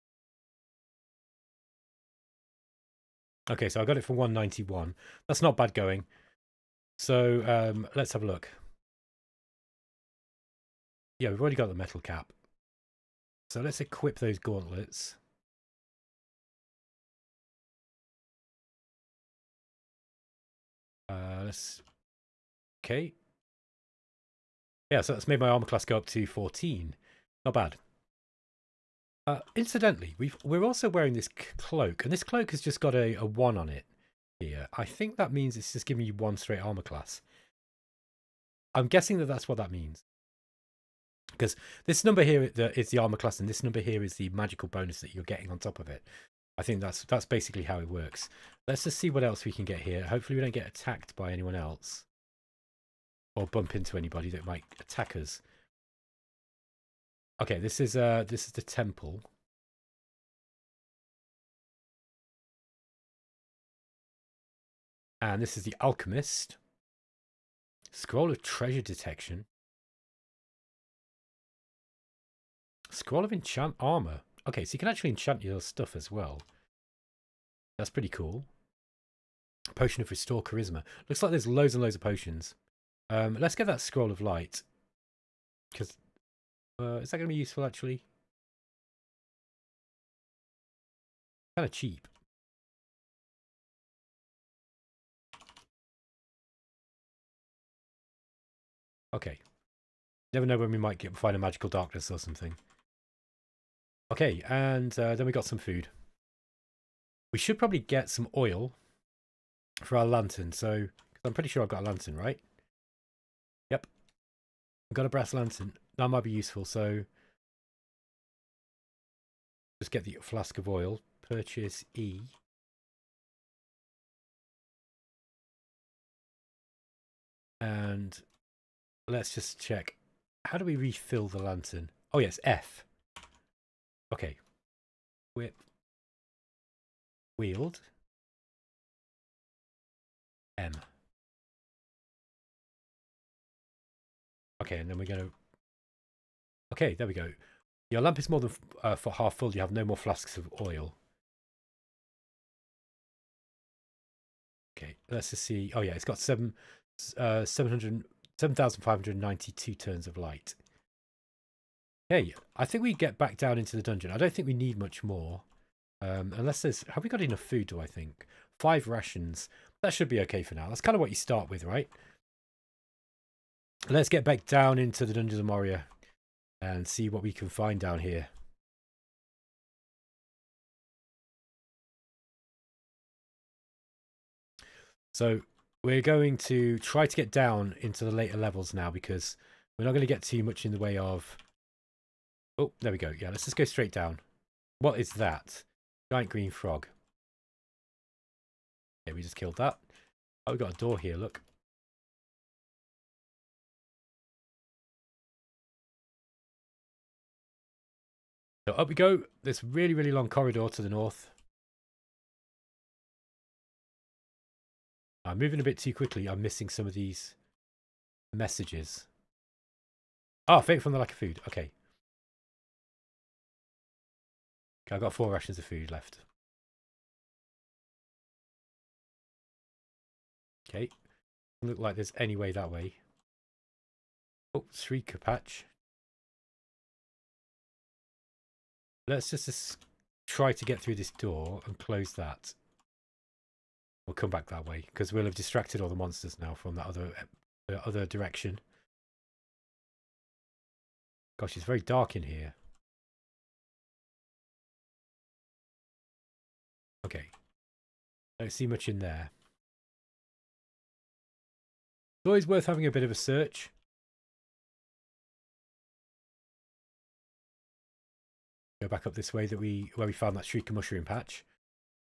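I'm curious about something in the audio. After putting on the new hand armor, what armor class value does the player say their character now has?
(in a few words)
14.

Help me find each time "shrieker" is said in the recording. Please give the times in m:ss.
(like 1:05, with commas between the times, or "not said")
3:54, 4:30.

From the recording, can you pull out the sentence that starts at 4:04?
We'll come back that way because we'll have distracted all the monsters now from that other eh, other direction.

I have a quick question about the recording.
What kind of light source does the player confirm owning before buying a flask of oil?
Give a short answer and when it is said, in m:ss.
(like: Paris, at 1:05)
Brass lantern, at 1:55.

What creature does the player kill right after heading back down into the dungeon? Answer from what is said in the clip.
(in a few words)
Giant green frog.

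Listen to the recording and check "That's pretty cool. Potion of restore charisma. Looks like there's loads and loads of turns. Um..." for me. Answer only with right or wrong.
wrong.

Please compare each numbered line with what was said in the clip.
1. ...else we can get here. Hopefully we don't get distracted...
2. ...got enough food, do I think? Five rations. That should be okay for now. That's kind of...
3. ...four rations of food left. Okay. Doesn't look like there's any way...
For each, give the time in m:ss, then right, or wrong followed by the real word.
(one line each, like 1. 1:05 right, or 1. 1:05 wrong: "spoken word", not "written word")
1. 0:49 wrong: "attacked", not "distracted"
2. 2:47 right
3. 3:45 right.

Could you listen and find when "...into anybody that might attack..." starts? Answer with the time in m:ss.
0:53.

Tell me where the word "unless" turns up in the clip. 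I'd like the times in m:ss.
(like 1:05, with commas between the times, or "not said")
2:46.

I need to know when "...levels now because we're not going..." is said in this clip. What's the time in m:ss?
3:08.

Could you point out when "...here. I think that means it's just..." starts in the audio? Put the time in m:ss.
0:34.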